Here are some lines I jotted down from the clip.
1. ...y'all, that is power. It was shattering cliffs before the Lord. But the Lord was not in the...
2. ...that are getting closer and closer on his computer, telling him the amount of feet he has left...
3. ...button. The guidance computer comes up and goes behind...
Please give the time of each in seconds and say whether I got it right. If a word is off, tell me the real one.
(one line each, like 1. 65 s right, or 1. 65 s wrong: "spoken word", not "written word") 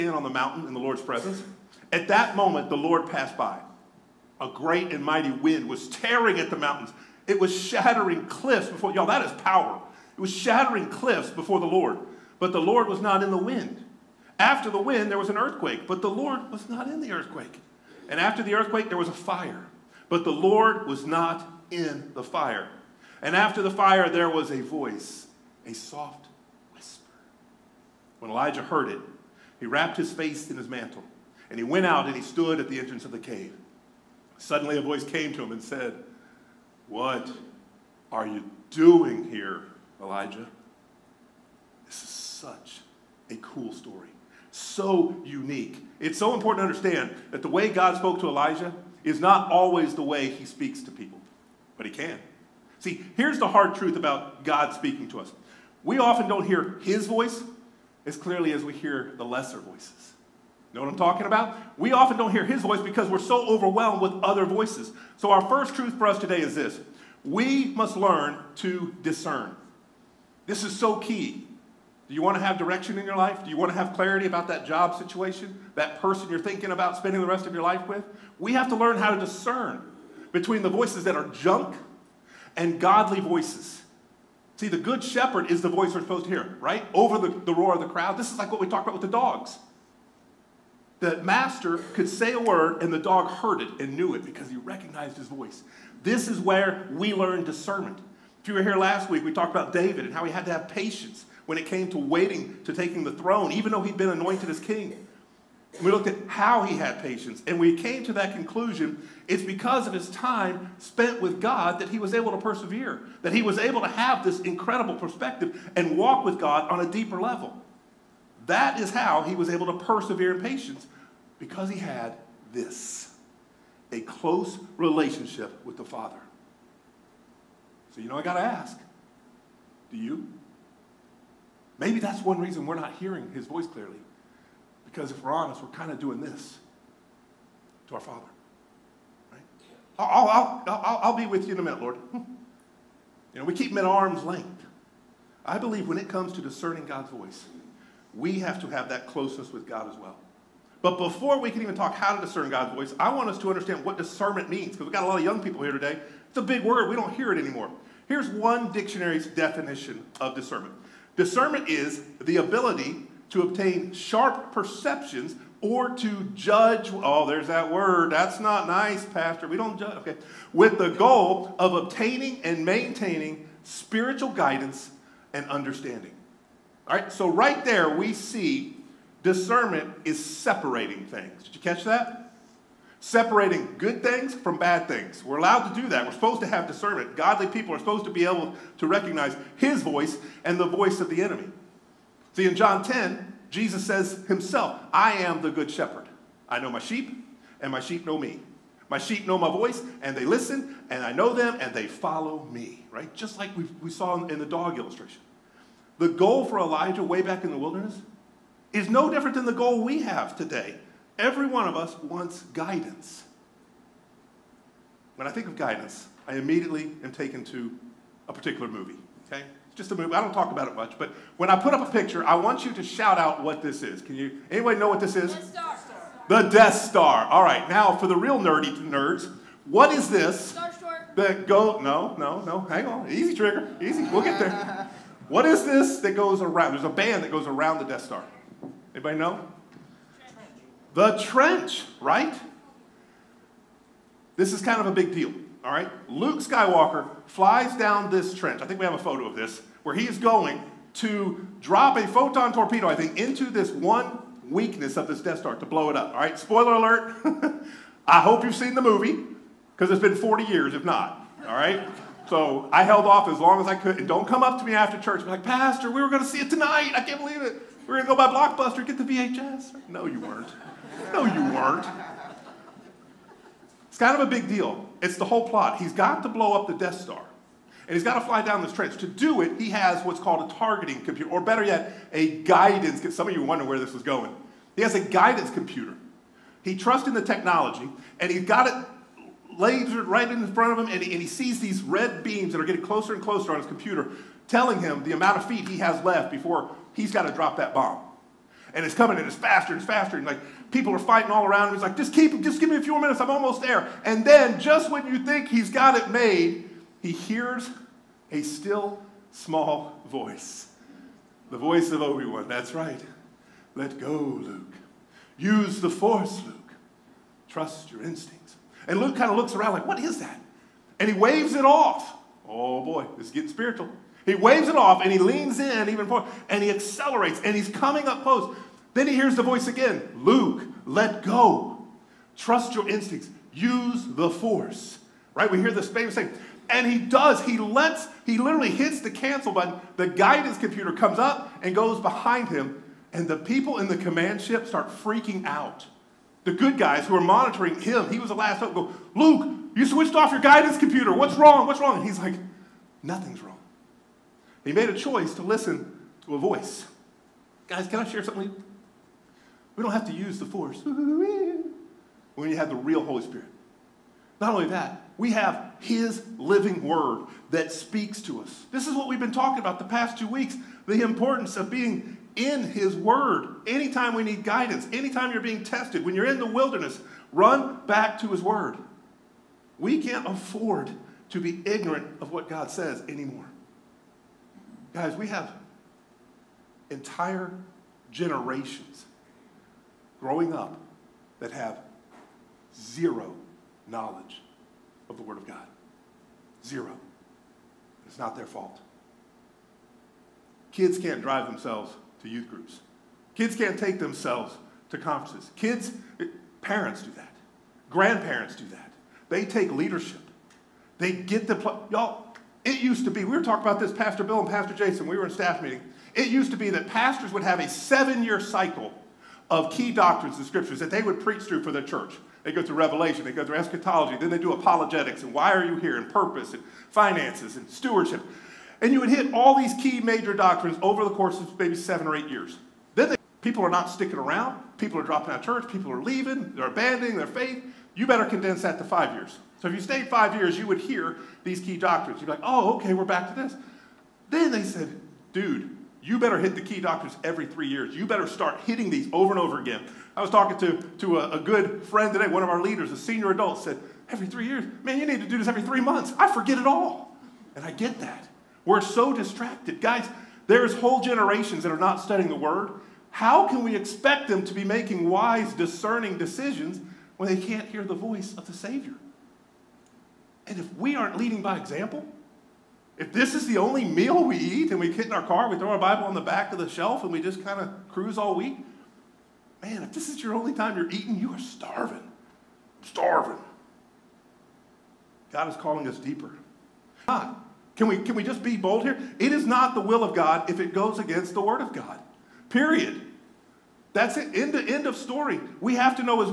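1. 8 s right
2. 292 s right
3. 339 s right.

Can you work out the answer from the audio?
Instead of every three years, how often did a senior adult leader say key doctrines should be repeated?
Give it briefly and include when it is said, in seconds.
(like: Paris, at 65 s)
Every 3 months, at 455 s.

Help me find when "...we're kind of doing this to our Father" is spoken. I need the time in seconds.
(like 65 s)
135 s.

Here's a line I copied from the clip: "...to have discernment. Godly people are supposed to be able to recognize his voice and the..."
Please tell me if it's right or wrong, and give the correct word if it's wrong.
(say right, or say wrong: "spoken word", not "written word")
right.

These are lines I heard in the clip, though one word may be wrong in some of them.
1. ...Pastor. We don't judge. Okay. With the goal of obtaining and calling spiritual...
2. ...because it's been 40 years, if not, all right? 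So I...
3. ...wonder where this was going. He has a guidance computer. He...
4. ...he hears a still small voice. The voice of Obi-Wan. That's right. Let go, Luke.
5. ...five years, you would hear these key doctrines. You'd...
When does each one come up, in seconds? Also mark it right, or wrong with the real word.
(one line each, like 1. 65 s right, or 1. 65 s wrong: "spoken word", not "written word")
1. 169 s wrong: "maintaining", not "calling"
2. 259 s right
3. 283 s right
4. 307 s right
5. 440 s right.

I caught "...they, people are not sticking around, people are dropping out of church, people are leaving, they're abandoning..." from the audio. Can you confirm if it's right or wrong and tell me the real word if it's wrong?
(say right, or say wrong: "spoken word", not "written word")
right.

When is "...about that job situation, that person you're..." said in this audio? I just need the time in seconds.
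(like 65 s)
74 s.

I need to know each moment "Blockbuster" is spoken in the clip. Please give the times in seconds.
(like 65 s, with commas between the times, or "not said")
268 s.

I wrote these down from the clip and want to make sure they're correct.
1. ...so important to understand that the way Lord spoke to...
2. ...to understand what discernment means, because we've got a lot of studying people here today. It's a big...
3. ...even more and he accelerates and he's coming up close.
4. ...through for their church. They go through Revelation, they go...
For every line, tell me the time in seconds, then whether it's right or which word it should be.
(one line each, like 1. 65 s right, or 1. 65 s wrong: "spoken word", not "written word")
1. 46 s wrong: "God", not "Lord"
2. 153 s wrong: "young", not "studying"
3. 325 s right
4. 421 s right.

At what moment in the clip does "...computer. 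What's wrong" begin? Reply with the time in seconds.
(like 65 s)
350 s.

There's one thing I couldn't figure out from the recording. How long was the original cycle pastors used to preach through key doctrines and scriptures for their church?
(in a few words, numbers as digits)
7 years.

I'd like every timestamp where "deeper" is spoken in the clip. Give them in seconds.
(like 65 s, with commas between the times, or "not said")
116 s, 485 s.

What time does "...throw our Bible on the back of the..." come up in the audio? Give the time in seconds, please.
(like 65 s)
475 s.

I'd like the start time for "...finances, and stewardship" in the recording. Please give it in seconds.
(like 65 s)
426 s.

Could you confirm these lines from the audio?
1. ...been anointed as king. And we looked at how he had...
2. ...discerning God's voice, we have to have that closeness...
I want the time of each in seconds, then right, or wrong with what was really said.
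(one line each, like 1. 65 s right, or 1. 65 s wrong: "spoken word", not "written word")
1. 103 s right
2. 146 s right.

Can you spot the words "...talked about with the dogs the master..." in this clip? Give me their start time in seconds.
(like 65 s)
88 s.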